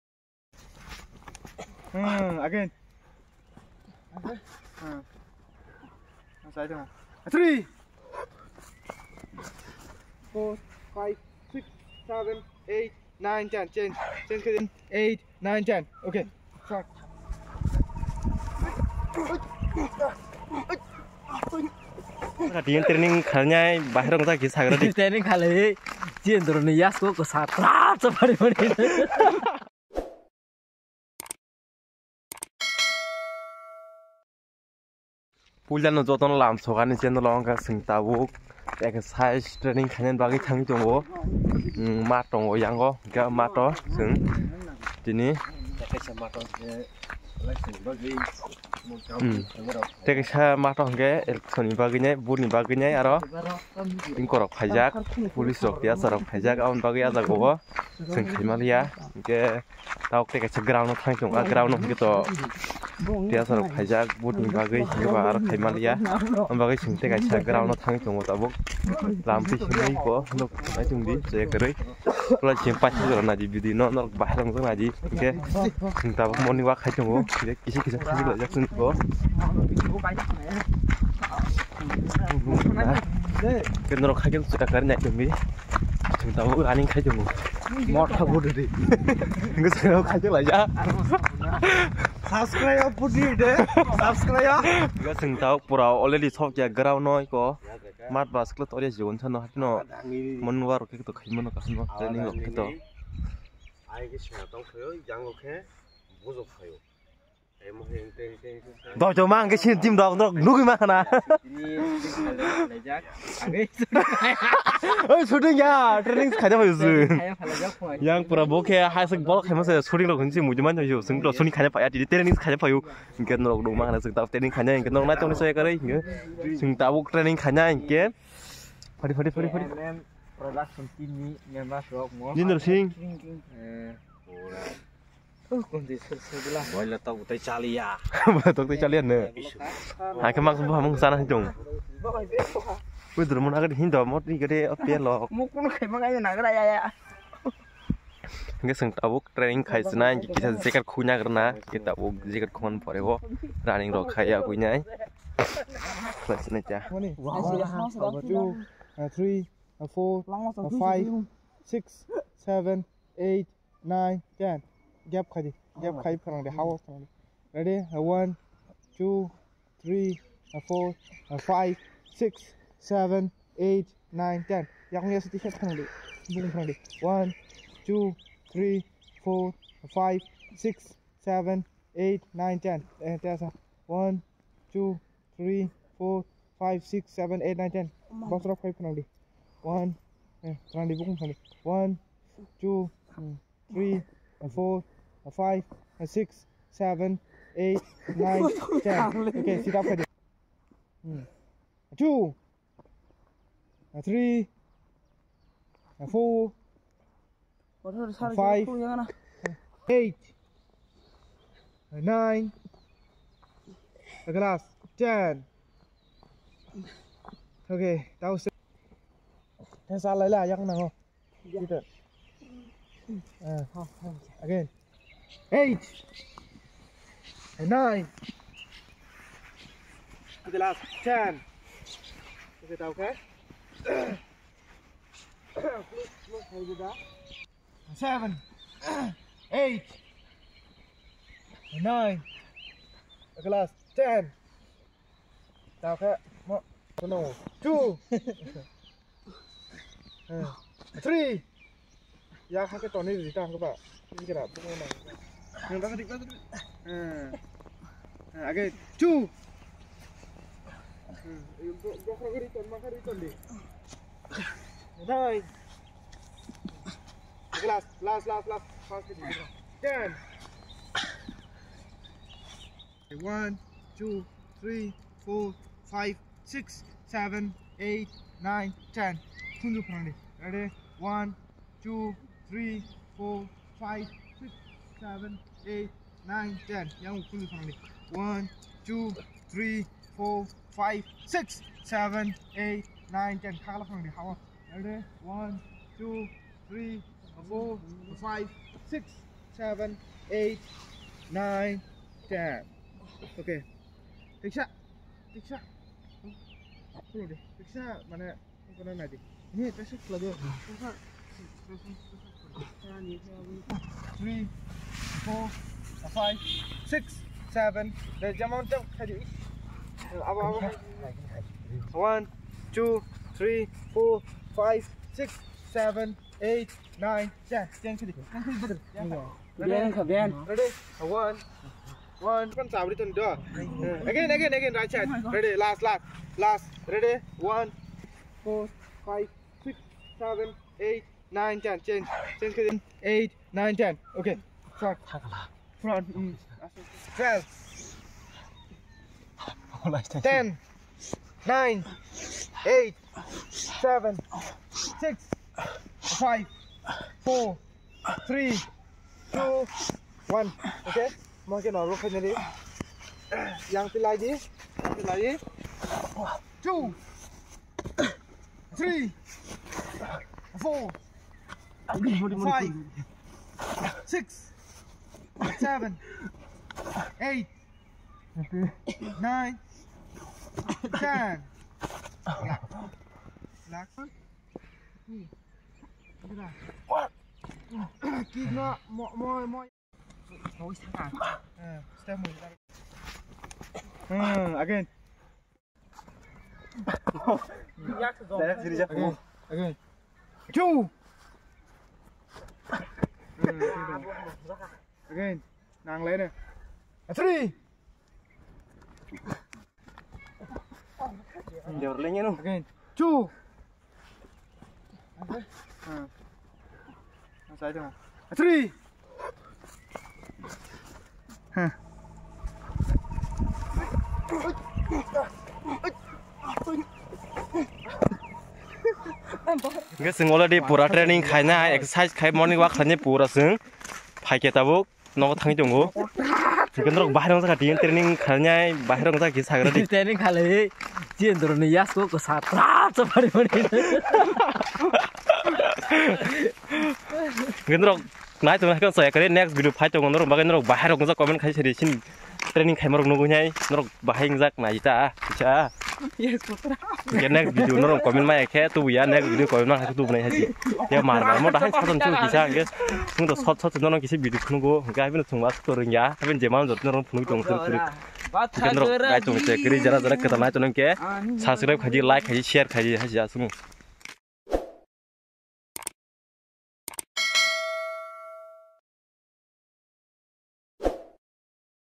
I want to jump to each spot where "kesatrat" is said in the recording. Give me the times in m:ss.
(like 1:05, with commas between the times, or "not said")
0:27.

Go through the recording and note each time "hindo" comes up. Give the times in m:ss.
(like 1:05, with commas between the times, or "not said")
2:23.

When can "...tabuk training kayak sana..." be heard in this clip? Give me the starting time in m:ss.
2:28.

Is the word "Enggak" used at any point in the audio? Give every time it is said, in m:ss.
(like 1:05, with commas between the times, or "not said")
1:29, 1:35, 2:28.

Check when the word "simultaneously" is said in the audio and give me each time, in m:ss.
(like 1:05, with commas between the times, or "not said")
not said.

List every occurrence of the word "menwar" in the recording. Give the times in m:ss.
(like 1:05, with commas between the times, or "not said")
1:40.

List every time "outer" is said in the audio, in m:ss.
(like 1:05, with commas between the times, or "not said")
not said.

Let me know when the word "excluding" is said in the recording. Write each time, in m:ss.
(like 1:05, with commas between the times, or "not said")
not said.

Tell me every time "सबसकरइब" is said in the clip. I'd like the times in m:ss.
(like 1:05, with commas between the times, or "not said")
7:50.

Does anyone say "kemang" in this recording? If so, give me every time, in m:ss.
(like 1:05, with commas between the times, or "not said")
2:20.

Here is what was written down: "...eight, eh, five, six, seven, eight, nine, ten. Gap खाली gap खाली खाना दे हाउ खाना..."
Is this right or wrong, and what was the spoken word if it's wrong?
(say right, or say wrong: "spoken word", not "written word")
wrong: "four", not "eight".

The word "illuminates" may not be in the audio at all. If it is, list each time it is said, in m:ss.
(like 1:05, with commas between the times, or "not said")
not said.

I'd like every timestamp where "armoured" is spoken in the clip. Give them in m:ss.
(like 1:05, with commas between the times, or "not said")
not said.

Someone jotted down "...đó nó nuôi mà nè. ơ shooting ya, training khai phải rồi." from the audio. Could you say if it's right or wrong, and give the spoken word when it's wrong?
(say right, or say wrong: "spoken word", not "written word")
right.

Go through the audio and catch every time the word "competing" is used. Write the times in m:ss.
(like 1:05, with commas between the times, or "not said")
not said.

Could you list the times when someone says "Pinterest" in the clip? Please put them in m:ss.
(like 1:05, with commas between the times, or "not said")
not said.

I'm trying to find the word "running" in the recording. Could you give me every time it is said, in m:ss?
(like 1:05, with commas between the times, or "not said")
1:26, 2:33.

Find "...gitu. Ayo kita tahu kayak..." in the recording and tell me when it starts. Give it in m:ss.
1:42.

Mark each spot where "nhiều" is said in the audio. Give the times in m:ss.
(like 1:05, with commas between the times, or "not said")
2:00.